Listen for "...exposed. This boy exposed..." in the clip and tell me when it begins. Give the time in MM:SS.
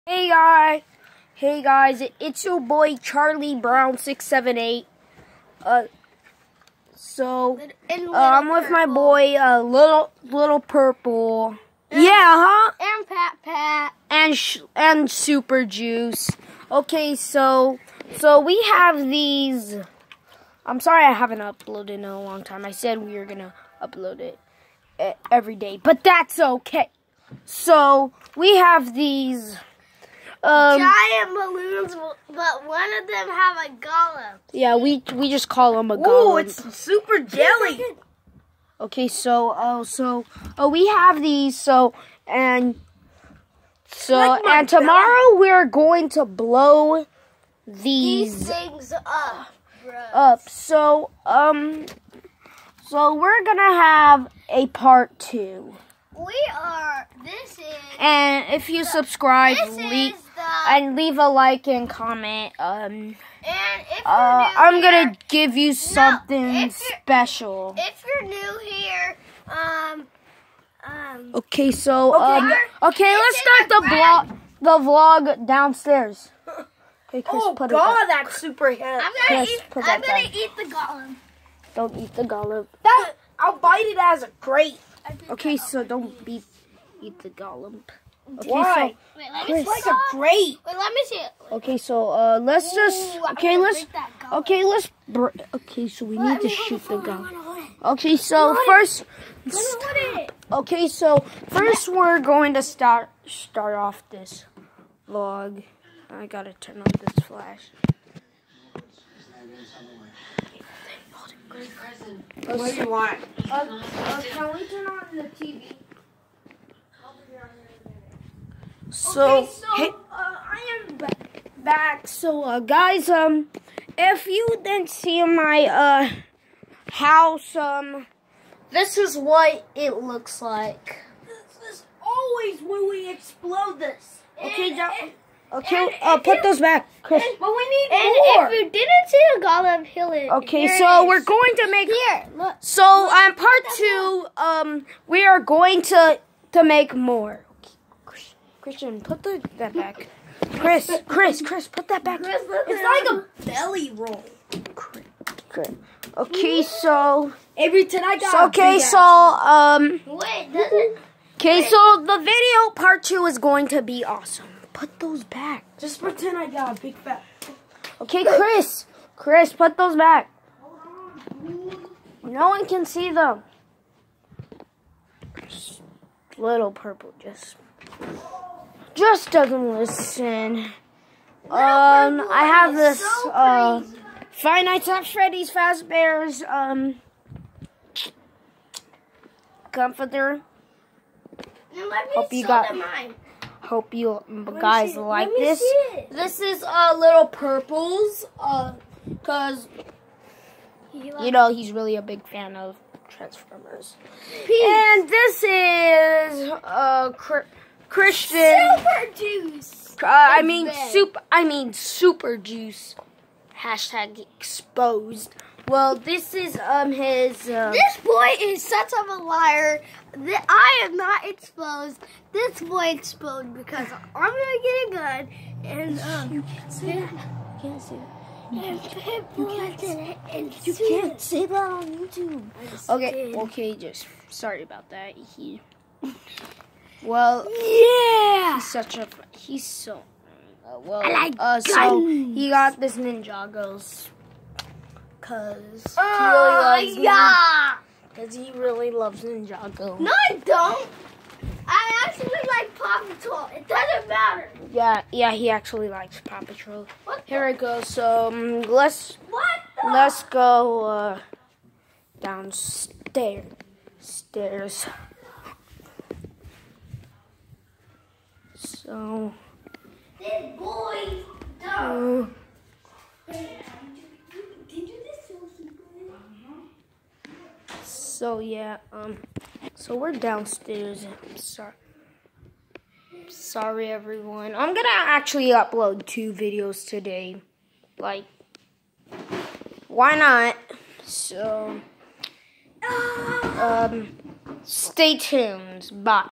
03:41.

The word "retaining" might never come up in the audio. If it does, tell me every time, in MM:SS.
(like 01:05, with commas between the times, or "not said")
not said.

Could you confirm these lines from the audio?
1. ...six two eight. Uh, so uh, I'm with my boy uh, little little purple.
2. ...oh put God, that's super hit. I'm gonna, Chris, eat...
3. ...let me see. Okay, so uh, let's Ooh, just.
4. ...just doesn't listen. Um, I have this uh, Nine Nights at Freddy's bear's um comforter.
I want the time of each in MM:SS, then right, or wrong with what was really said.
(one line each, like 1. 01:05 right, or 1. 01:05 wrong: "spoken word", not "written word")
1. 00:03 wrong: "seven", not "two"
2. 01:17 right
3. 01:30 right
4. 02:58 wrong: "Five", not "Nine".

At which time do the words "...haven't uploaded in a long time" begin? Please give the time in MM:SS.
00:21.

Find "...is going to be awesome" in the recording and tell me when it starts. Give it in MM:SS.
02:43.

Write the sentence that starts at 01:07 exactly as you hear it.
If you're new here, um, um.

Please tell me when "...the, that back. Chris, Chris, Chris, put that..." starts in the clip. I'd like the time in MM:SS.
02:29.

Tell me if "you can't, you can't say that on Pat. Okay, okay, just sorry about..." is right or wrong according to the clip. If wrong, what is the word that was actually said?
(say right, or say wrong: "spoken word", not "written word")
wrong: "YouTube", not "Pat".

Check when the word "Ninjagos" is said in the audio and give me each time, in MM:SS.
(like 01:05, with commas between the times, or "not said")
04:02, 04:09.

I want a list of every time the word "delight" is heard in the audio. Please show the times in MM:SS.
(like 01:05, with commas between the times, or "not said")
not said.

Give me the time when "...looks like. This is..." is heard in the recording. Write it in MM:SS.
02:10.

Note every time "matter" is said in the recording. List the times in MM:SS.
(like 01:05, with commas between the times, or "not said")
04:14.